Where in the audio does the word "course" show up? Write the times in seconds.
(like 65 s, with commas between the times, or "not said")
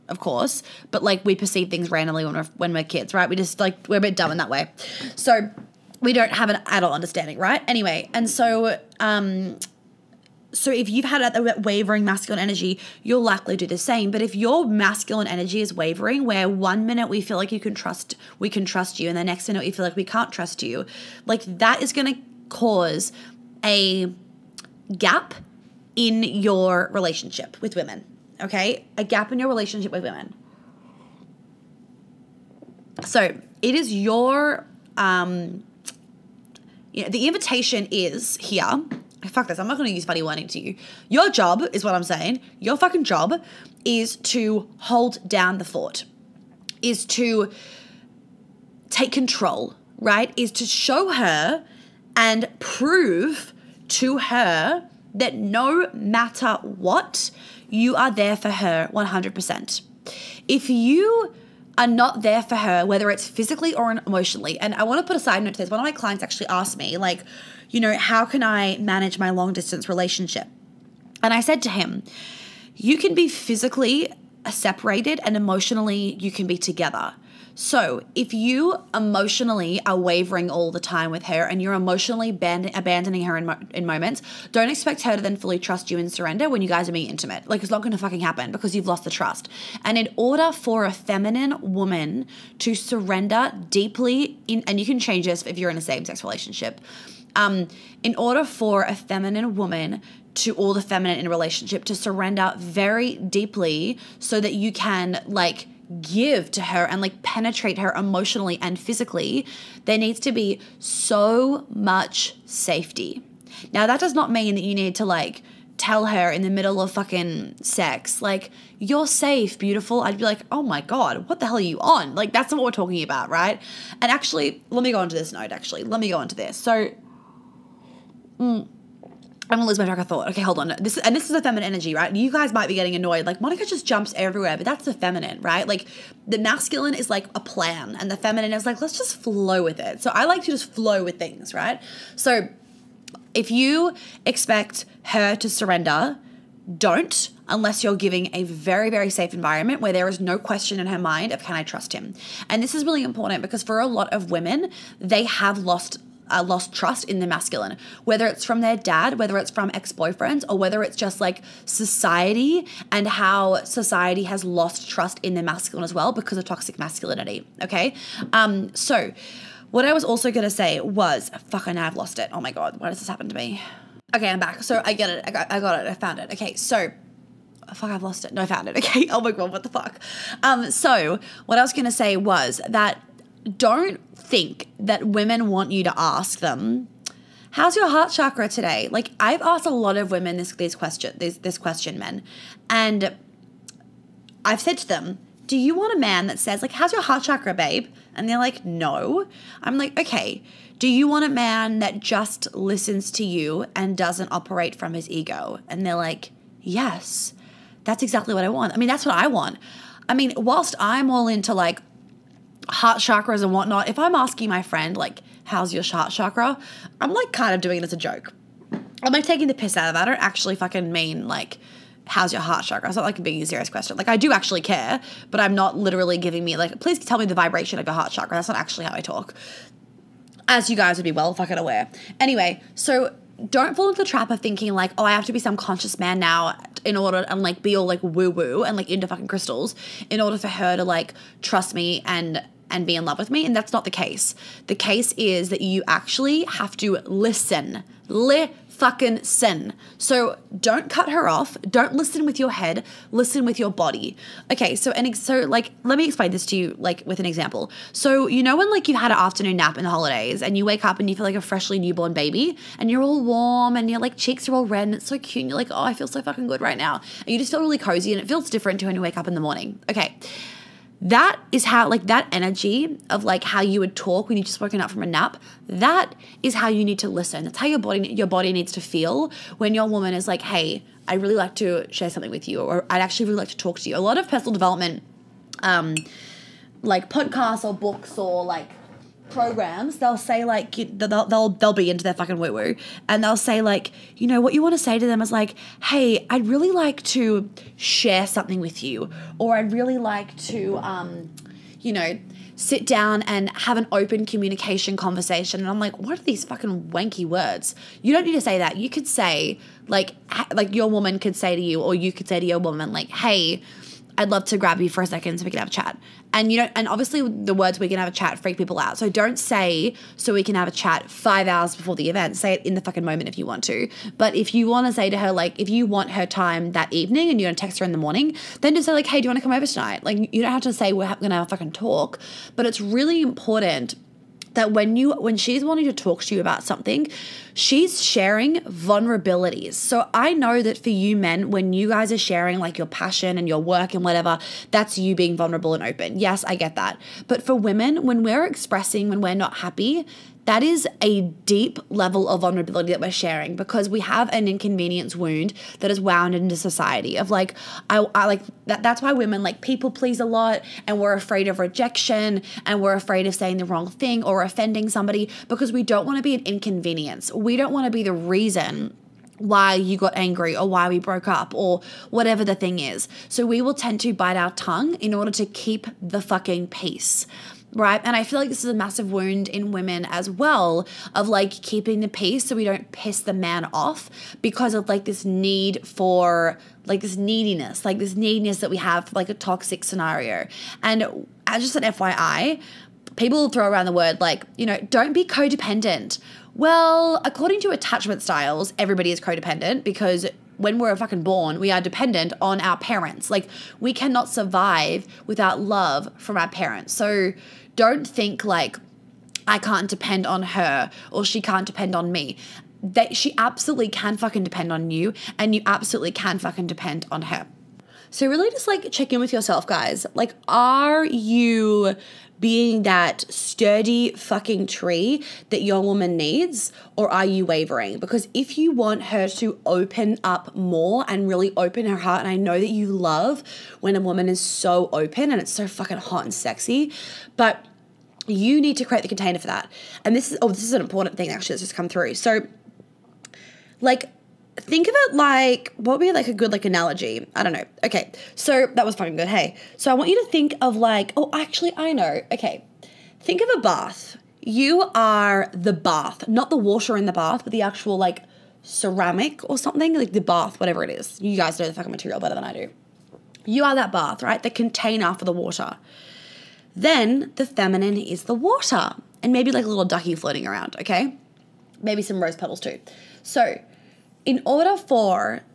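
0 s.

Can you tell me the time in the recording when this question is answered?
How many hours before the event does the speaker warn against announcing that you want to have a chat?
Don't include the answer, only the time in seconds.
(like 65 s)
321 s.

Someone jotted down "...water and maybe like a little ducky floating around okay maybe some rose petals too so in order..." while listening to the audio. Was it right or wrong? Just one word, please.
right.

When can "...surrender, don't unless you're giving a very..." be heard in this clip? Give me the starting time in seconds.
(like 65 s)
145 s.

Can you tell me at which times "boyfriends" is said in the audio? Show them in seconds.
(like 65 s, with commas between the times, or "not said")
159 s.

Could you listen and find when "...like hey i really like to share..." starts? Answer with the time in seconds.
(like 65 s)
280 s.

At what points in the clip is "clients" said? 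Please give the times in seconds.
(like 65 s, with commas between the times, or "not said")
65 s.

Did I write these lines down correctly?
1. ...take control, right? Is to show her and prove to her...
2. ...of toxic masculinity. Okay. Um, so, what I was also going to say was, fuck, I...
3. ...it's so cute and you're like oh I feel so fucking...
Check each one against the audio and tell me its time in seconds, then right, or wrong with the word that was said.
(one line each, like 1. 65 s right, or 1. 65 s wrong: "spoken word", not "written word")
1. 48 s right
2. 166 s right
3. 264 s right.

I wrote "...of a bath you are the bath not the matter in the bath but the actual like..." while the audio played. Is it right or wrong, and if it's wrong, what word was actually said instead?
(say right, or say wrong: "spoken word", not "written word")
wrong: "water", not "matter".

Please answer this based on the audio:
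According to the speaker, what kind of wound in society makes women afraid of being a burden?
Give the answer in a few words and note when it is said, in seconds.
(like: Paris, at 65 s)
inconvenience wound, at 354 s.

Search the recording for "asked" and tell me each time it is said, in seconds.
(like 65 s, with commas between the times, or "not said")
66 s, 189 s.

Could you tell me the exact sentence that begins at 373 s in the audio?
So we will tend to bite our tongue in order to keep the fucking peace right?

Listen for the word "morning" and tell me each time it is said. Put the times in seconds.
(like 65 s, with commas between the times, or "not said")
269 s, 327 s.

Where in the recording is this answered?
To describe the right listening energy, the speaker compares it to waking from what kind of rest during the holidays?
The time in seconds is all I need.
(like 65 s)
259 s.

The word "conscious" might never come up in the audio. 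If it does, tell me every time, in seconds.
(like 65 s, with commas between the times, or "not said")
235 s.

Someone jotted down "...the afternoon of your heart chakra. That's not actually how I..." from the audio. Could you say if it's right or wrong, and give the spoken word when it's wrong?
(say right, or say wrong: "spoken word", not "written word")
wrong: "vibration", not "afternoon".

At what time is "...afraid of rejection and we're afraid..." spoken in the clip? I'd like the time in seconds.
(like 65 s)
361 s.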